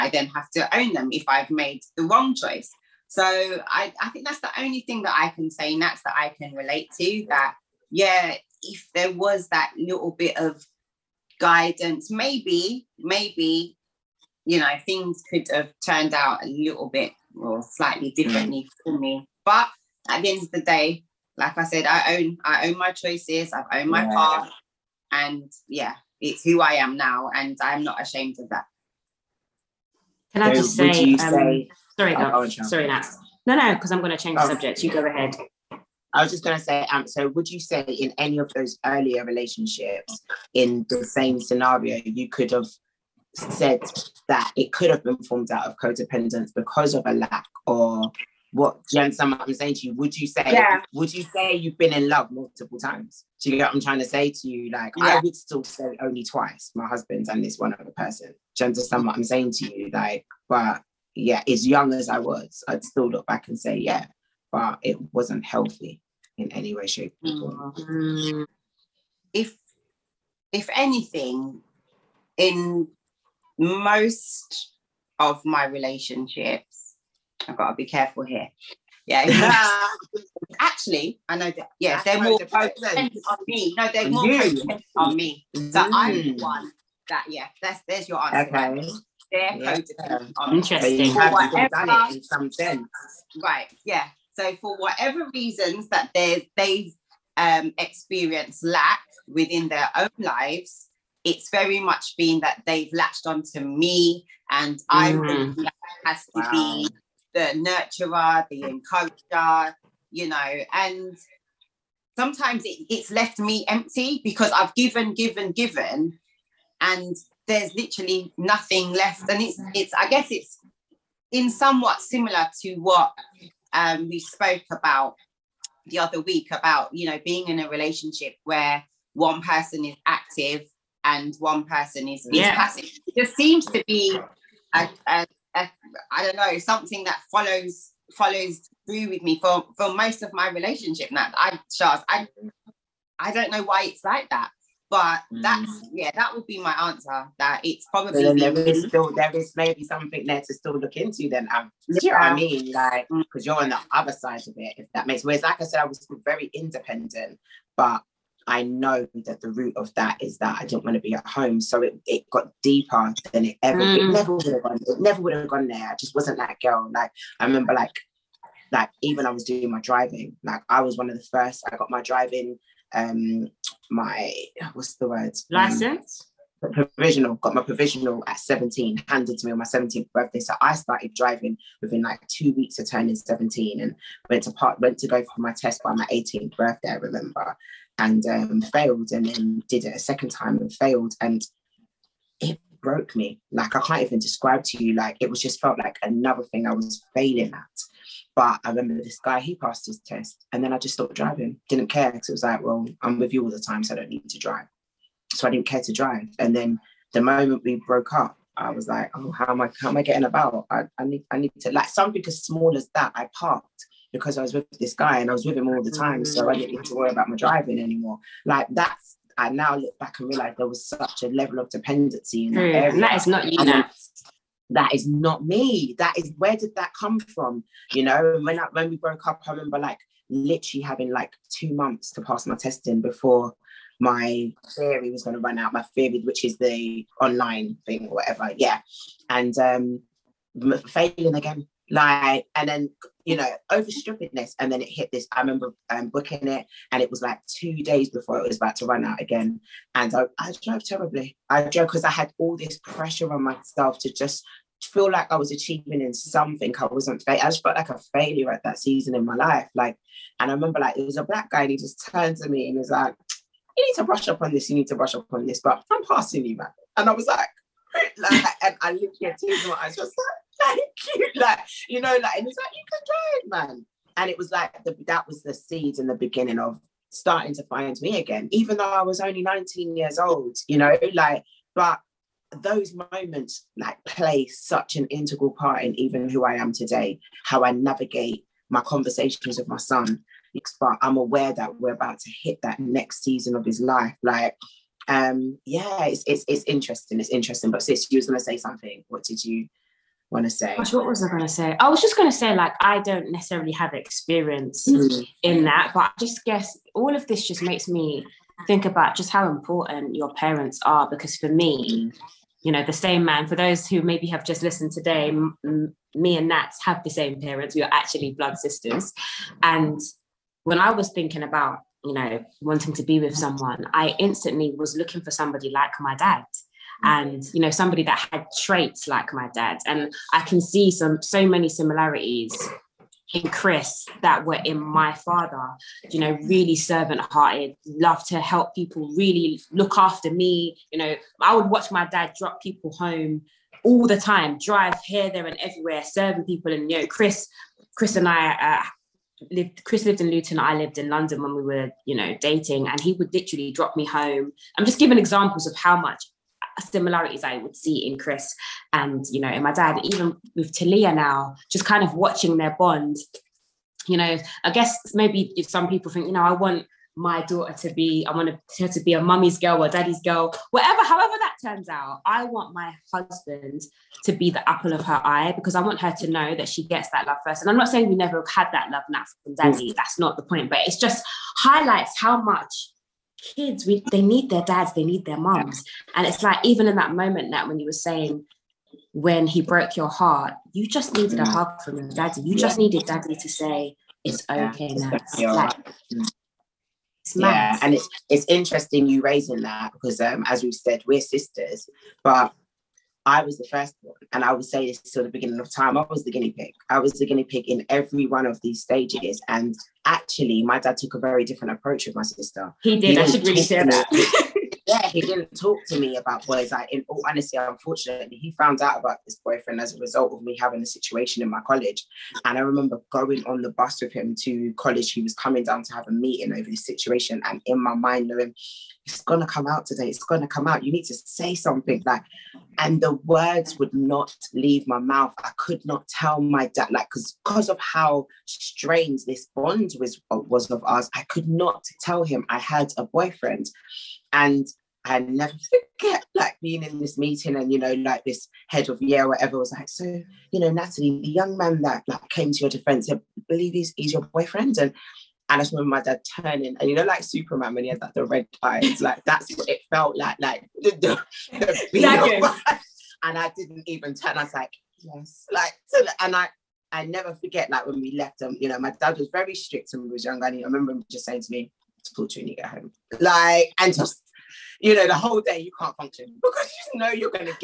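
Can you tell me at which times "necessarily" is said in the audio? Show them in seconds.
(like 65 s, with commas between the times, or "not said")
303 s.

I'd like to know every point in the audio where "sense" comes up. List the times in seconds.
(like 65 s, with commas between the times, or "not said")
92 s, 155 s.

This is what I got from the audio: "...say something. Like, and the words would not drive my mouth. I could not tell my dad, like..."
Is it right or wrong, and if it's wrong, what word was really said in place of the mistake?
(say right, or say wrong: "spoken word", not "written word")
wrong: "leave", not "drive".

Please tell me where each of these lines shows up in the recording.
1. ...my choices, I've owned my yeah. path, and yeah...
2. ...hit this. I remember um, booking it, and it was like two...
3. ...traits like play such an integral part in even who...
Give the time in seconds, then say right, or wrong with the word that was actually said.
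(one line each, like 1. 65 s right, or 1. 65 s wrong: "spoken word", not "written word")
1. 22 s right
2. 244 s right
3. 283 s wrong: "moments", not "traits".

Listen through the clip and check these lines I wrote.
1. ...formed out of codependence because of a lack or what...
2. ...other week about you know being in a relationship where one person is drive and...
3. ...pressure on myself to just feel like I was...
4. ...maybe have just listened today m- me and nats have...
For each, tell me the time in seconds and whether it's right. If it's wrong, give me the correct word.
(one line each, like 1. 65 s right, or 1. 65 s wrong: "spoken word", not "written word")
1. 45 s right
2. 125 s wrong: "active", not "drive"
3. 252 s right
4. 314 s right.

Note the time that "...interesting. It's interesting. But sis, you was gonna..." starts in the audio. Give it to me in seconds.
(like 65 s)
296 s.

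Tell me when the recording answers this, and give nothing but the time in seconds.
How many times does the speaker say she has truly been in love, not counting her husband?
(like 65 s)
56 s.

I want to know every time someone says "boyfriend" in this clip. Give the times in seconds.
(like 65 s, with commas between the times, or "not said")
419 s, 443 s, 454 s.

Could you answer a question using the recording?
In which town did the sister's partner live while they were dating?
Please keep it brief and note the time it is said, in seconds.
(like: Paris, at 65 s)
Luton, at 350 s.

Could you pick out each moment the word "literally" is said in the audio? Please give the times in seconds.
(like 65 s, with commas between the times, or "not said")
117 s, 230 s, 353 s.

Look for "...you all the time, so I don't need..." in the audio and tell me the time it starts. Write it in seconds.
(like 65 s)
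203 s.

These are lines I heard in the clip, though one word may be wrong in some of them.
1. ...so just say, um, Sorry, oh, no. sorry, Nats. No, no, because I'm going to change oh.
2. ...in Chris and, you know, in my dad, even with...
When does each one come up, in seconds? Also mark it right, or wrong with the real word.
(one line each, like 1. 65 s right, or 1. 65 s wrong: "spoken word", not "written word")
1. 30 s right
2. 358 s right.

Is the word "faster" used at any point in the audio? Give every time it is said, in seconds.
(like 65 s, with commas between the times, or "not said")
not said.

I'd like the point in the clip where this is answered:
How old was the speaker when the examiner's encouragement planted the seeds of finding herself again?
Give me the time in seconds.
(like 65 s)
279 s.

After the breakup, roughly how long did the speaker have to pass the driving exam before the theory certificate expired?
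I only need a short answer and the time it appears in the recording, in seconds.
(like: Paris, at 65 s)
2 months, at 231 s.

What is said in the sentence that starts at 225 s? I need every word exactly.
That is where did that come from?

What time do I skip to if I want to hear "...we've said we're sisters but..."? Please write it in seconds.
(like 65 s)
400 s.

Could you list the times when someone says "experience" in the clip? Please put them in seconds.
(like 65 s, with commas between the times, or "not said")
97 s, 303 s.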